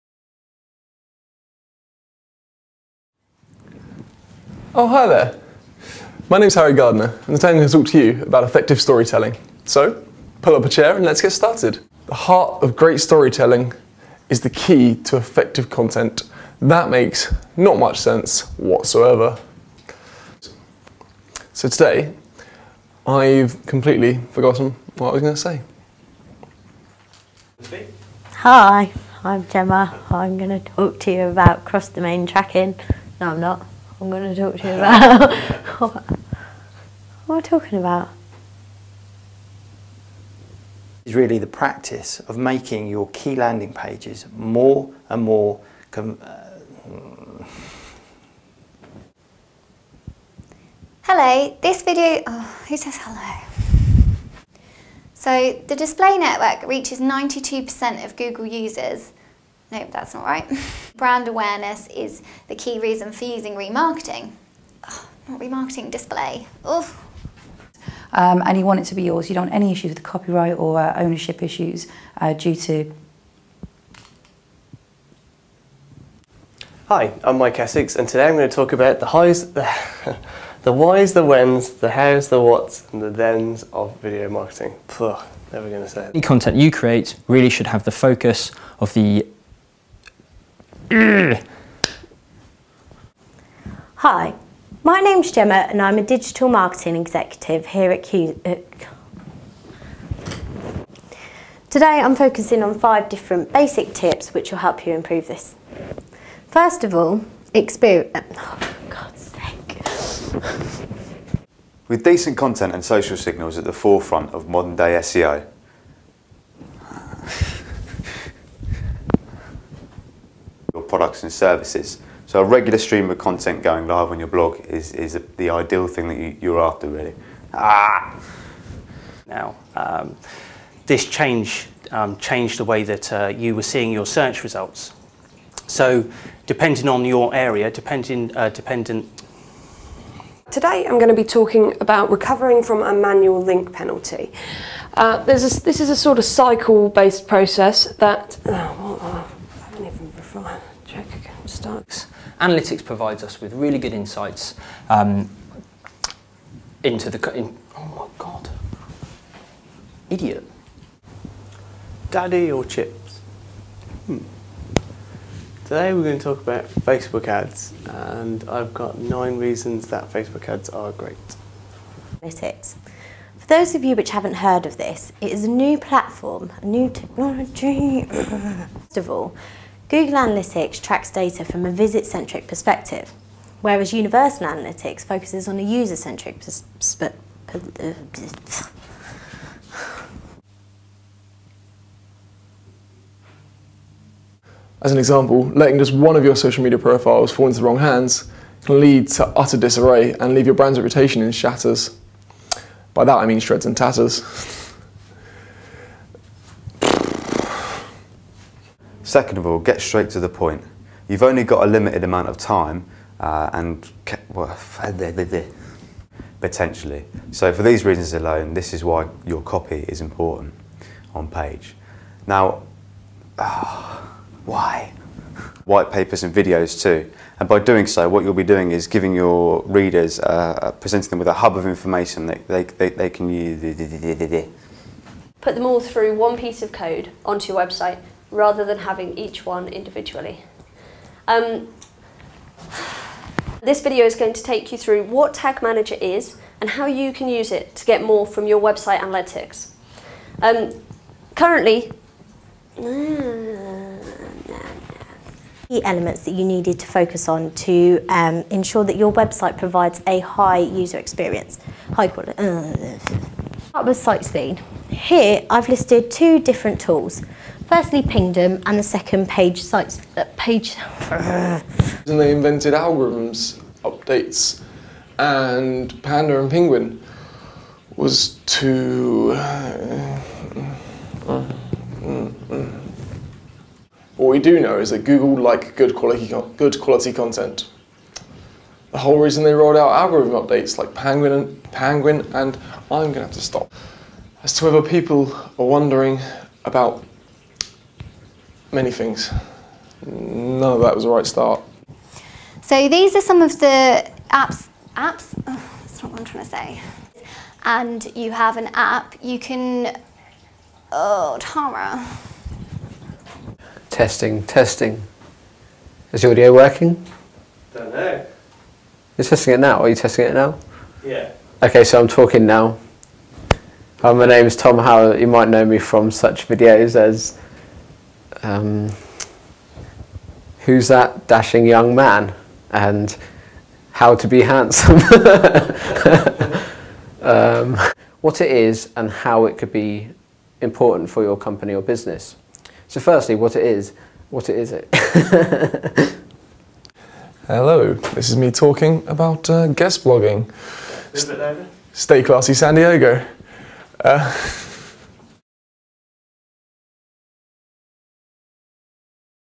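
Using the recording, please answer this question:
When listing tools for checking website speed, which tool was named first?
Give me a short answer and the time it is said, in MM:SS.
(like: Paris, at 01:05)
Pingdom, at 04:28.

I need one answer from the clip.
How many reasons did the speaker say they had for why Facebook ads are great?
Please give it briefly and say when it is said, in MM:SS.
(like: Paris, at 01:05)
9, at 02:48.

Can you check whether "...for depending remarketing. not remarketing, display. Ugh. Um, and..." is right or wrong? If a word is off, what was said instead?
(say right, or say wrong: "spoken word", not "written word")
wrong: "using", not "depending".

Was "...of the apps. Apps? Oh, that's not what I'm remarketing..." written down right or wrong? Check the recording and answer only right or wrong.
wrong.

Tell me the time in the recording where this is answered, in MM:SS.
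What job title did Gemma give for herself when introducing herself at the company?
01:36.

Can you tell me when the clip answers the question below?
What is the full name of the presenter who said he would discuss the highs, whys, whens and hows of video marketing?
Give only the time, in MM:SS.
01:17.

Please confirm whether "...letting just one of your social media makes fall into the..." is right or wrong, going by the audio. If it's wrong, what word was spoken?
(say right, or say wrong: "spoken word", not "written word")
wrong: "profiles", not "makes".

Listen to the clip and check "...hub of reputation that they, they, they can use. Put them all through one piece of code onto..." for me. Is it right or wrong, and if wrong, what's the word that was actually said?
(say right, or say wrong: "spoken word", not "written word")
wrong: "information", not "reputation".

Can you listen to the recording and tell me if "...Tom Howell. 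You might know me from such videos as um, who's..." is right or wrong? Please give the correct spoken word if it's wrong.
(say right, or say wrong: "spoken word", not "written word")
right.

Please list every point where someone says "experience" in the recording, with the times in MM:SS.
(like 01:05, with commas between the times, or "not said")
01:47, 04:20.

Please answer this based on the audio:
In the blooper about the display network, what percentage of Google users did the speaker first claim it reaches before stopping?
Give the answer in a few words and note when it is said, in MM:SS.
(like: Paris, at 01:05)
92%, at 00:56.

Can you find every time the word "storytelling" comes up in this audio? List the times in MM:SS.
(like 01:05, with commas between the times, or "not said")
00:08, 00:13.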